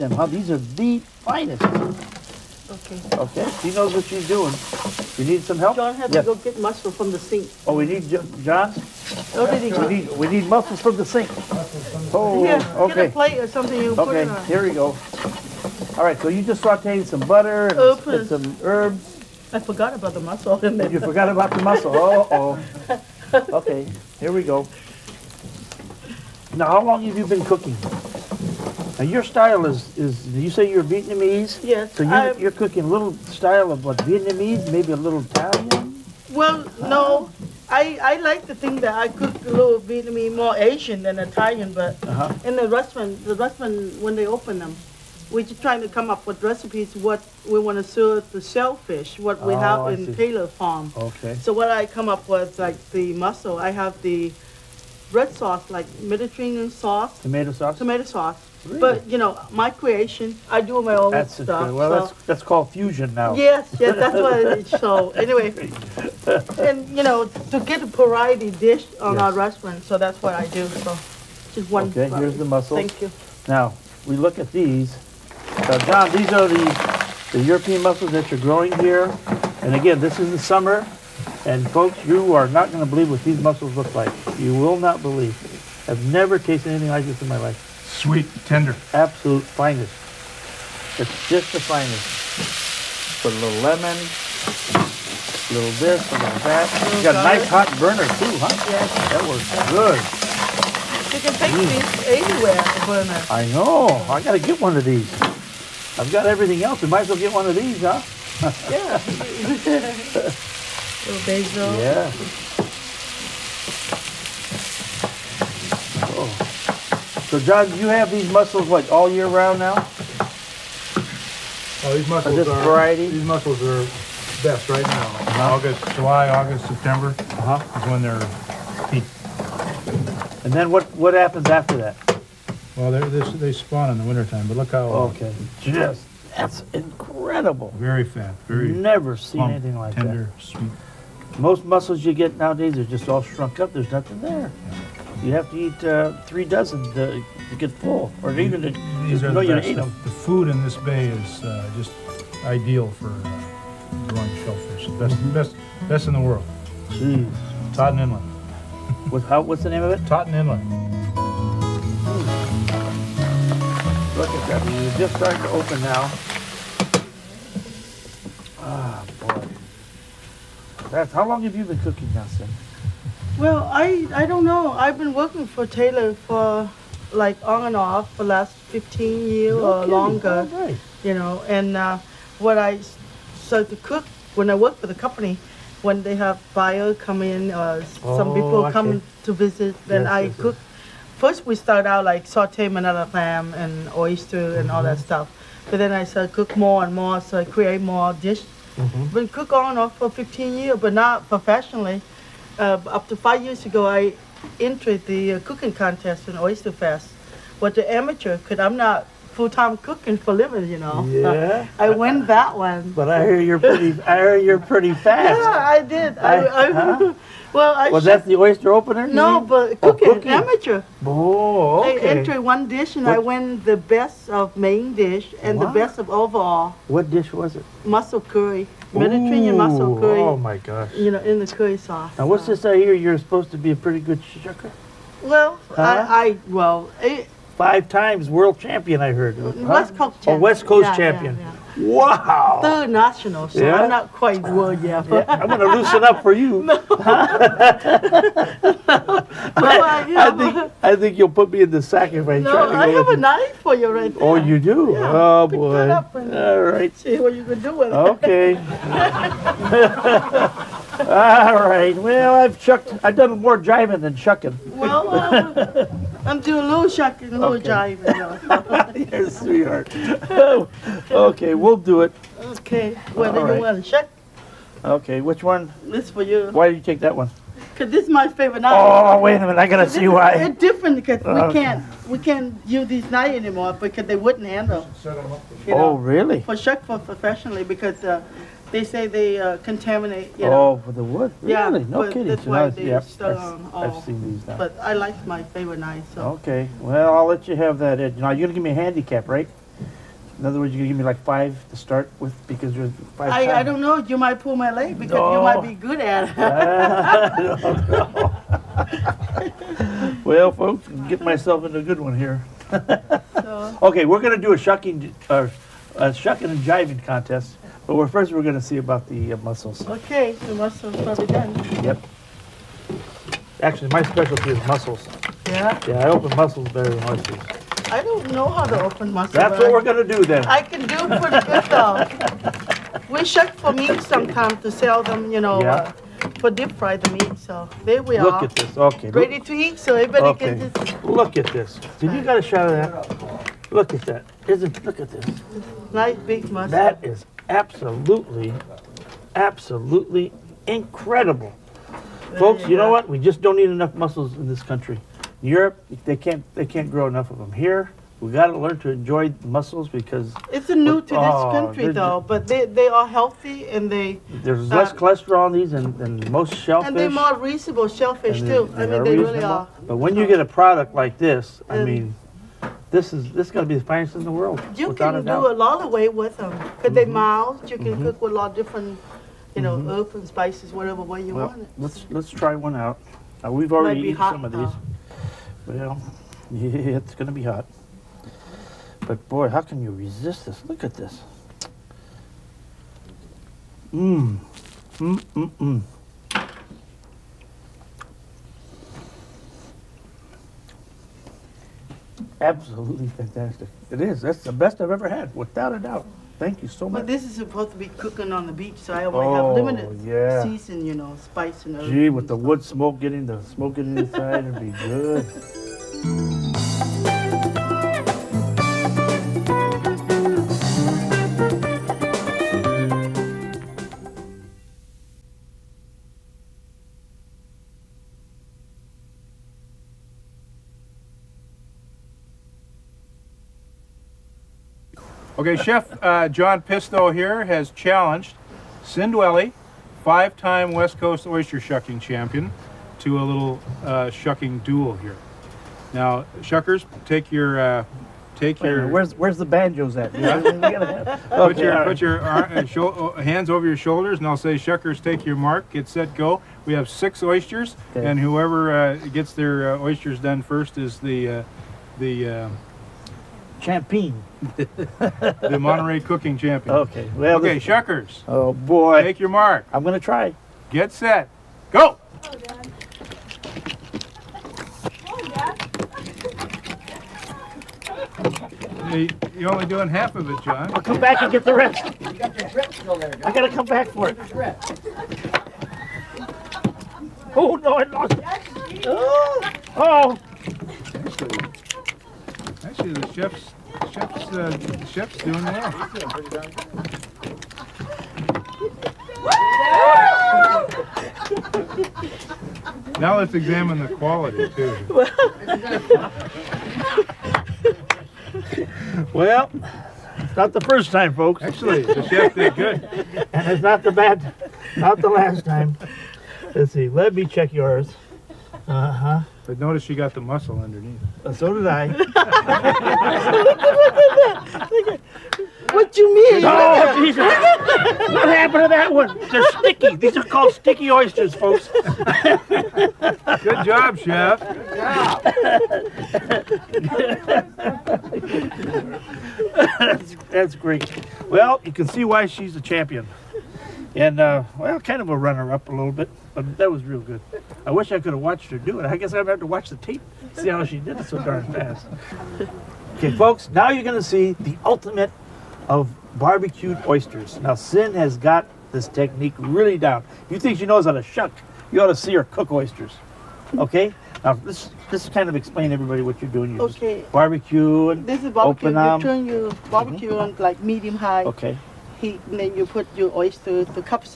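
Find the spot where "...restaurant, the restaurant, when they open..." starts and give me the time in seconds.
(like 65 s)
42 s.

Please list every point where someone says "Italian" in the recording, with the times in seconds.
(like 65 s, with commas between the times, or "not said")
35 s, 41 s.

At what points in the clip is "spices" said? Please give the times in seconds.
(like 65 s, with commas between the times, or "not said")
380 s, 411 s.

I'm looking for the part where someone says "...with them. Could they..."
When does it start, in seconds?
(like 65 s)
376 s.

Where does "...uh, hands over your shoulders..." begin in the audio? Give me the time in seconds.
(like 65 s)
452 s.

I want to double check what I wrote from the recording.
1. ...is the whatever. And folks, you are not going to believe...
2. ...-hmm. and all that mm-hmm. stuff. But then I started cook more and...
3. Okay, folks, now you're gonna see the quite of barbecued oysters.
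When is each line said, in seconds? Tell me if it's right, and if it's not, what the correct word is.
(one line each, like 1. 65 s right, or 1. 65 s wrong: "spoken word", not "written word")
1. 80 s wrong: "summer", not "whatever"
2. 194 s right
3. 552 s wrong: "ultimate", not "quite".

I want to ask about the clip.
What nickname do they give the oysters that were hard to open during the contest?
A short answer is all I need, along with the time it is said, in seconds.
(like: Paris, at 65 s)
Sticky oysters, at 530 s.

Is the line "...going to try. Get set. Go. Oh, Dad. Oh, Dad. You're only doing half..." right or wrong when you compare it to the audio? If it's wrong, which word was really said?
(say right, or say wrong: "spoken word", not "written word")
right.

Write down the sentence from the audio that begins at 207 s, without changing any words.
What the amateur could, I'm not full-time cooking for living, you know.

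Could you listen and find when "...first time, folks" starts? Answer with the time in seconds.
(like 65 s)
510 s.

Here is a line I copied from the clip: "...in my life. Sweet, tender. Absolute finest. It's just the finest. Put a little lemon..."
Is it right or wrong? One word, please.
right.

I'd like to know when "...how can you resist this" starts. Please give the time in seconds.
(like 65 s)
389 s.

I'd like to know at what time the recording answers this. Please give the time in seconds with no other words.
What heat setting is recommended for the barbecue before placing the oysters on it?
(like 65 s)
570 s.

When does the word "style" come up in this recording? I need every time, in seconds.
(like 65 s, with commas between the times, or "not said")
29 s, 33 s.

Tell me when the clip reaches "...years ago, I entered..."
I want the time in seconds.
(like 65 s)
203 s.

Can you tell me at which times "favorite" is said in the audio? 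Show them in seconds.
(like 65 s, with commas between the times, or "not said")
278 s, 295 s.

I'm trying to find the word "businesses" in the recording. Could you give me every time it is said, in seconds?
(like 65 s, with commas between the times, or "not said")
not said.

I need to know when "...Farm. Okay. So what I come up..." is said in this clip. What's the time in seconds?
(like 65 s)
50 s.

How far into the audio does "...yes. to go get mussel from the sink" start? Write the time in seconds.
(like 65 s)
6 s.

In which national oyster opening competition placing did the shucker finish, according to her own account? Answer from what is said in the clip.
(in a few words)
Third.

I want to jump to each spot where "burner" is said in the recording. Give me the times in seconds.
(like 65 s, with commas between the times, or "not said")
97 s, 102 s.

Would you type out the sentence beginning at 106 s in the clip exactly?
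We might as well get one of these, huh?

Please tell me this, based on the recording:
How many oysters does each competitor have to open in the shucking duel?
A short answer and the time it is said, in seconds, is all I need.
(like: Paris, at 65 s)
6, at 456 s.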